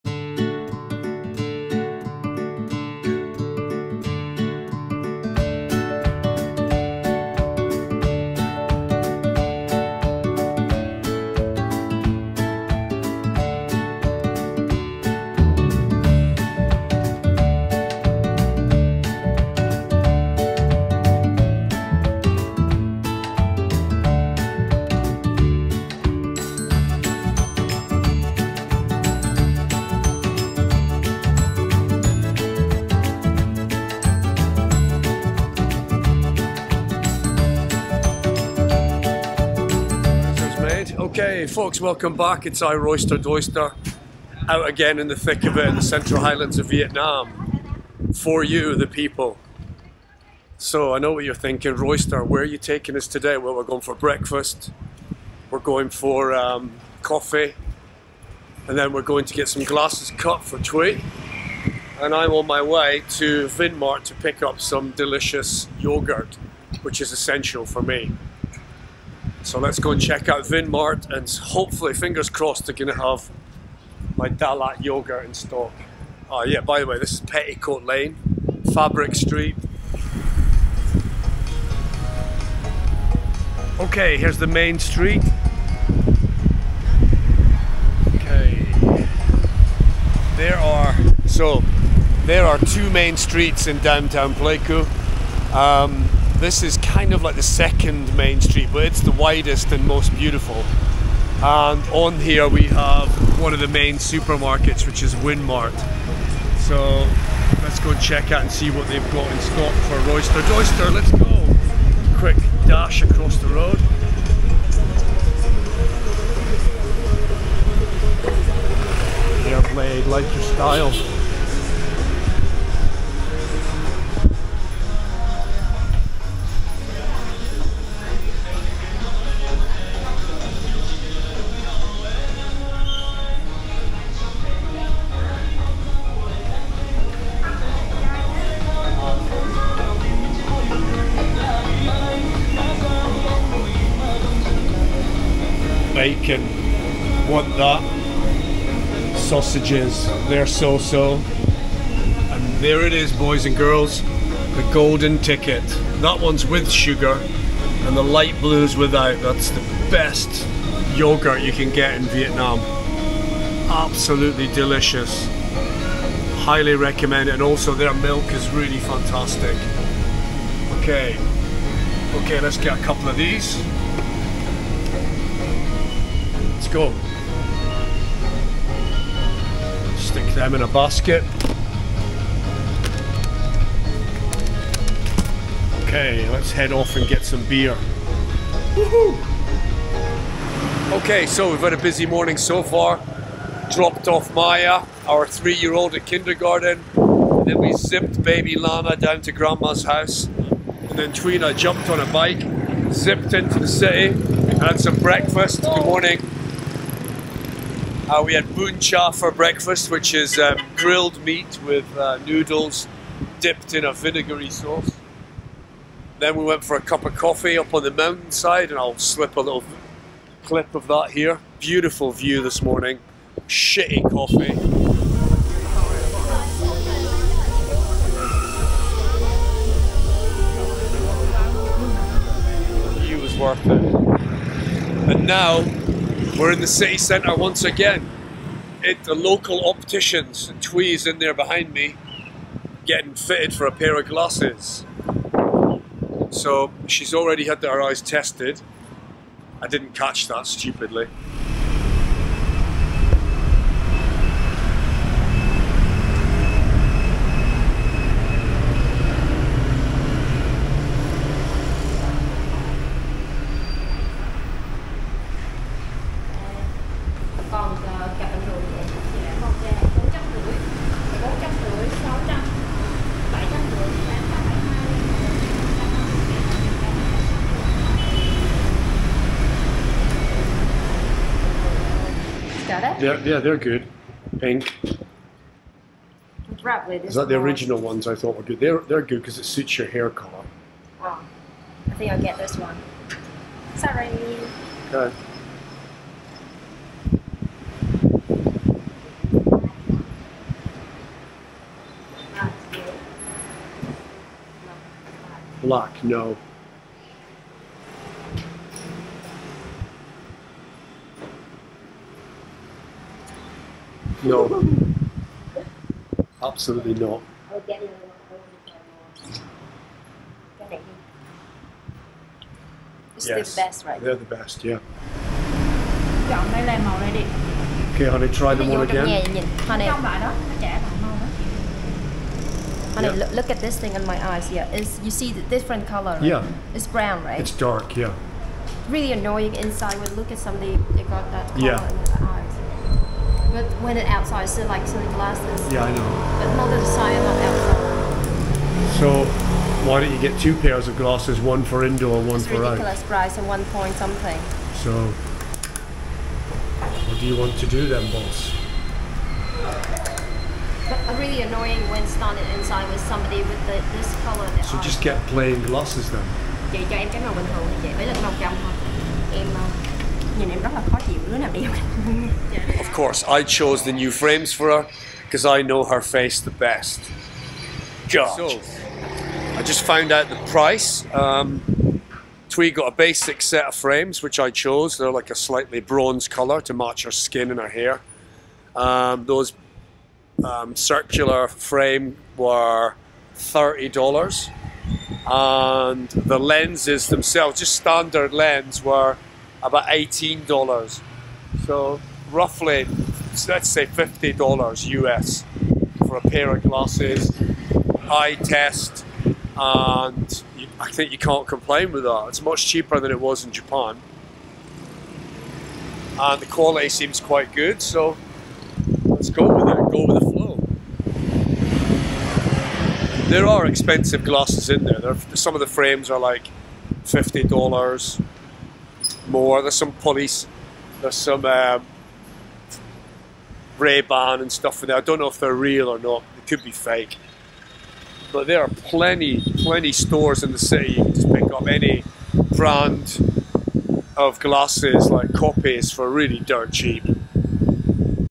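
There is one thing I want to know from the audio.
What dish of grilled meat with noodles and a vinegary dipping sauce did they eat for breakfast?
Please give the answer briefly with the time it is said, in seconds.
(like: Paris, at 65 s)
Chả, at 208 s.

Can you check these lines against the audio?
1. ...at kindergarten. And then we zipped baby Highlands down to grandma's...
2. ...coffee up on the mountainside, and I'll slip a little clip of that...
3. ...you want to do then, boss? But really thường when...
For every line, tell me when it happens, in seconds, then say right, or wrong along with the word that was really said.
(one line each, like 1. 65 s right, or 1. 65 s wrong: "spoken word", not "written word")
1. 195 s wrong: "Lana", not "Highlands"
2. 217 s right
3. 357 s wrong: "annoying", not "thường".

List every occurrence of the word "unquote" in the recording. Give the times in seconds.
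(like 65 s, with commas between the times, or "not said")
not said.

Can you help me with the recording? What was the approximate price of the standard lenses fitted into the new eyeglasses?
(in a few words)
$18.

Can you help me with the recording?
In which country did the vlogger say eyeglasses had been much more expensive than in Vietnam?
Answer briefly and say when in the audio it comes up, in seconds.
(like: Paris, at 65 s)
Japan, at 413 s.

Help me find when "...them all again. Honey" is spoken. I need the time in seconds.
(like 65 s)
328 s.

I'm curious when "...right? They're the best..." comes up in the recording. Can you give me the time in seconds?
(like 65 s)
323 s.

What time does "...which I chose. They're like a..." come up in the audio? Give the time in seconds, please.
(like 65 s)
384 s.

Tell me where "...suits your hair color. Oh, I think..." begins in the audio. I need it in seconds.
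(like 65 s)
289 s.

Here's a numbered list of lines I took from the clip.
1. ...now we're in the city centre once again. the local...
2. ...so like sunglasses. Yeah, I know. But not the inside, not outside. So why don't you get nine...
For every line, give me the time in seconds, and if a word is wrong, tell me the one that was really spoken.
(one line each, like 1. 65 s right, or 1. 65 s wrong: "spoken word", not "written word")
1. 235 s right
2. 344 s wrong: "two", not "nine".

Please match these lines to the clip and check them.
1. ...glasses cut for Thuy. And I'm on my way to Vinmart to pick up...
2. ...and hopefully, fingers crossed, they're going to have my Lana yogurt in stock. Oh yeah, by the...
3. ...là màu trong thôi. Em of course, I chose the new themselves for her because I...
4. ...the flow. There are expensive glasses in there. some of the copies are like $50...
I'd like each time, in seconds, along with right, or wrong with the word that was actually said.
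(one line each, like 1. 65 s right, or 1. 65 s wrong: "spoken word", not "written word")
1. 59 s right
2. 71 s wrong: "Dalat", not "Lana"
3. 368 s wrong: "frames", not "themselves"
4. 420 s wrong: "frames", not "copies".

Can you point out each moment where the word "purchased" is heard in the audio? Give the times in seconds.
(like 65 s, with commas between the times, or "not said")
not said.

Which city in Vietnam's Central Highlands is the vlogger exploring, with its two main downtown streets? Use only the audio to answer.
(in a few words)
Pleiku.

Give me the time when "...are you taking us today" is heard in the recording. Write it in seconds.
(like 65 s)
52 s.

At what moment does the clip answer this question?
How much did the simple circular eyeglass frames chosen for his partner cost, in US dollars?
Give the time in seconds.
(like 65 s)
393 s.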